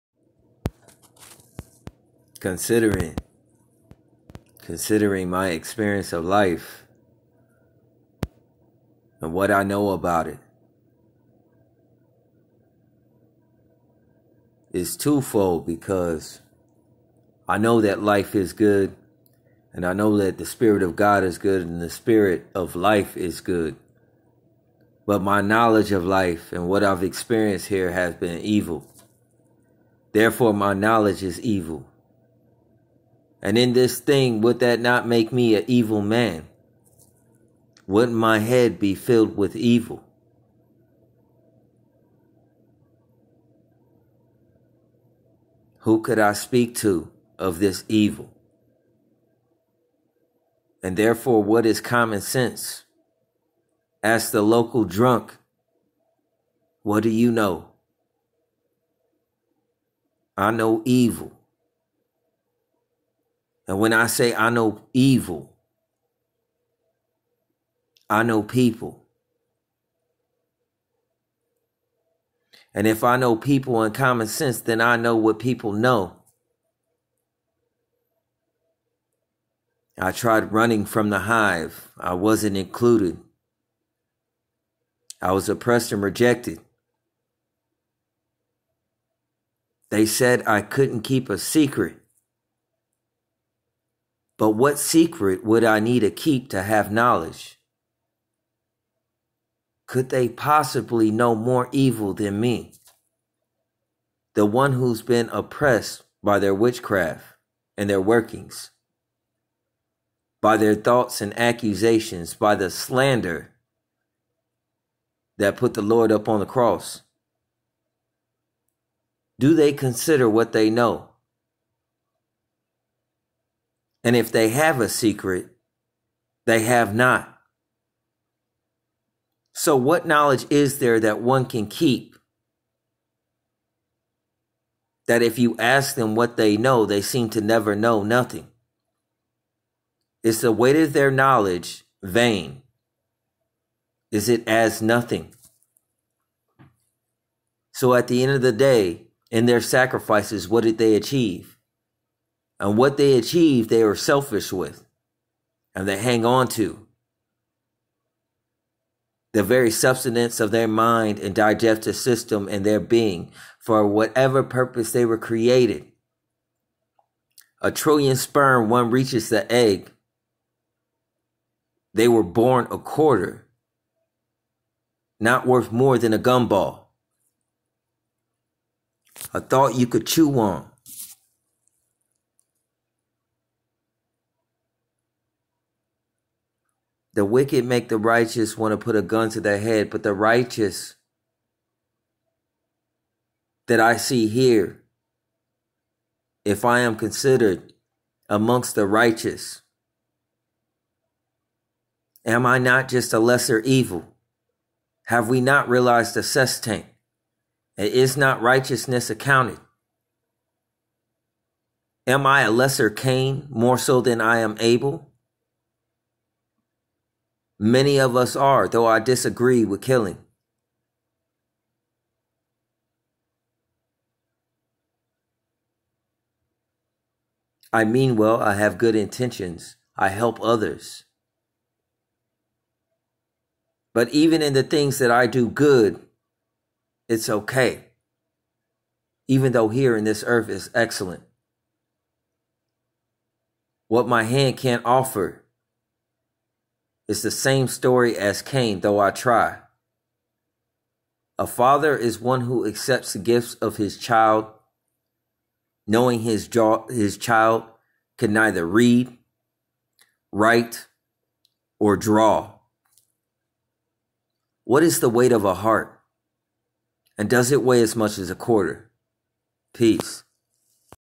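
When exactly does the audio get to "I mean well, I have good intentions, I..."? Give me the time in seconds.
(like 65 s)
227 s.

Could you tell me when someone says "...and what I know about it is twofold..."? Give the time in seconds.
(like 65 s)
9 s.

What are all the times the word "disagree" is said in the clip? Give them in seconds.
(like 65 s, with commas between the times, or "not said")
218 s.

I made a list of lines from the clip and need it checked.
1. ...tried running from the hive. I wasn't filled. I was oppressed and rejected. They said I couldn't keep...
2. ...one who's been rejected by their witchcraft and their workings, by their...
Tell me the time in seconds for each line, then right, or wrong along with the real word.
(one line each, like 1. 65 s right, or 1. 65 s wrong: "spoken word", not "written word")
1. 80 s wrong: "included", not "filled"
2. 104 s wrong: "oppressed", not "rejected".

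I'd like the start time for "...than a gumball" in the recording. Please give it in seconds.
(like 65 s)
175 s.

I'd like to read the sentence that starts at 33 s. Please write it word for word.
And in this thing, would that not make me an evil man?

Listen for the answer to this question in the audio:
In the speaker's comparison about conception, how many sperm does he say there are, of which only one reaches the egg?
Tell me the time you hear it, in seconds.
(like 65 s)
167 s.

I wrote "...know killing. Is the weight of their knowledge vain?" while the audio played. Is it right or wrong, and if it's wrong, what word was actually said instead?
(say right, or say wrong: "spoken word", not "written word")
wrong: "nothing", not "killing".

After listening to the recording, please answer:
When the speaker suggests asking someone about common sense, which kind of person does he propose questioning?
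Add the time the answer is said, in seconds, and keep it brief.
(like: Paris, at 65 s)
the local drunk, at 54 s.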